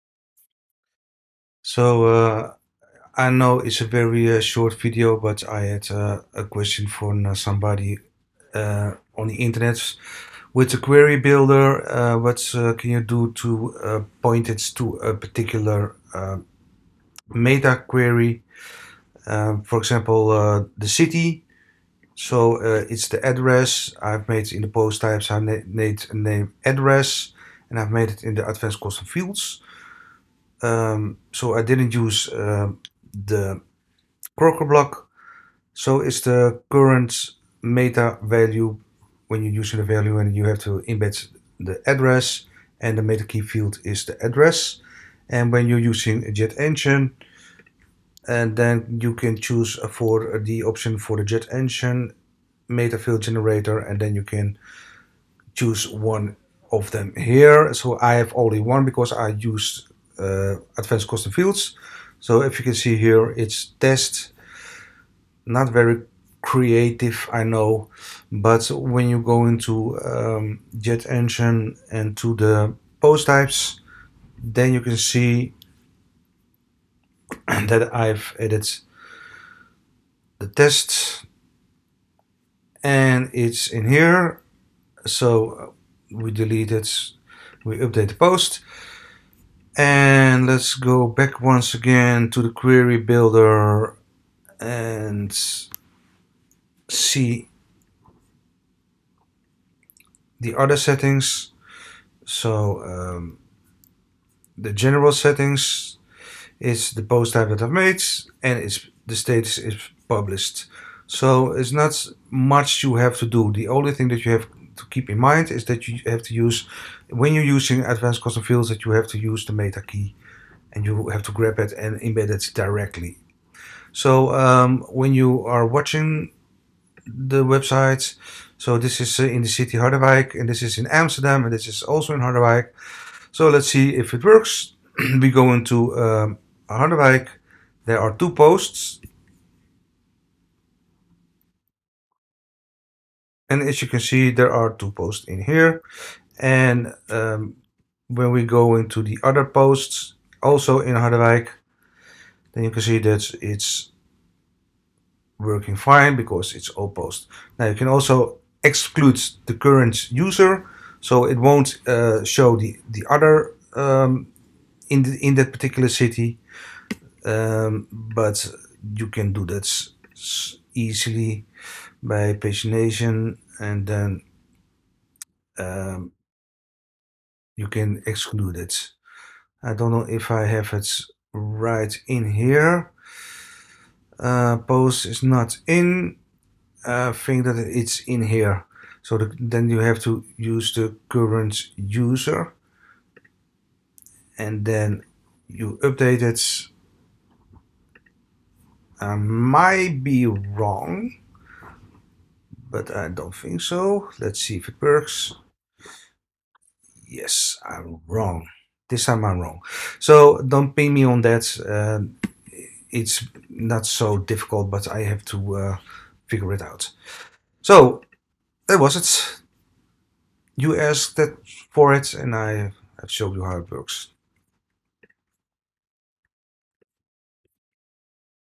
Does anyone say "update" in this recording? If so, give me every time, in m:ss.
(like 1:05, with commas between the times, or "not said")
1:27, 3:15.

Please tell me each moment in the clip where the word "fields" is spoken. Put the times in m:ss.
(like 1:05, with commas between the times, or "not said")
0:29, 0:43, 0:52, 1:01, 1:58.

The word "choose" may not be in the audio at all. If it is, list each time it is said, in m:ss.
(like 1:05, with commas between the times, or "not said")
0:49, 0:55.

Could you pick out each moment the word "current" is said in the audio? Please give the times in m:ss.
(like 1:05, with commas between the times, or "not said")
0:36, 2:39, 3:11.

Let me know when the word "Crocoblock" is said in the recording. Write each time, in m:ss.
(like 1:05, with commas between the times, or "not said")
0:34.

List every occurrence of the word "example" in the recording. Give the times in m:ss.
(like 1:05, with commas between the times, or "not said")
0:19.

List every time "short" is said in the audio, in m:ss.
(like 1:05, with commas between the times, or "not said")
0:04.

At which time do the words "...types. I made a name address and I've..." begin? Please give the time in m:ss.
0:24.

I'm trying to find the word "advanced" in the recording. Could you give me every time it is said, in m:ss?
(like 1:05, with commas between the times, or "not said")
0:28, 1:00, 1:57.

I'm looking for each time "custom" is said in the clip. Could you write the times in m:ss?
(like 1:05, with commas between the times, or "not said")
0:28, 1:01, 1:58.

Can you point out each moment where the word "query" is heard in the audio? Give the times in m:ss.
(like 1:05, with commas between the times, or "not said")
0:10, 0:17, 1:32.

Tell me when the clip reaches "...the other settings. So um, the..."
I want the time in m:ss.
1:40.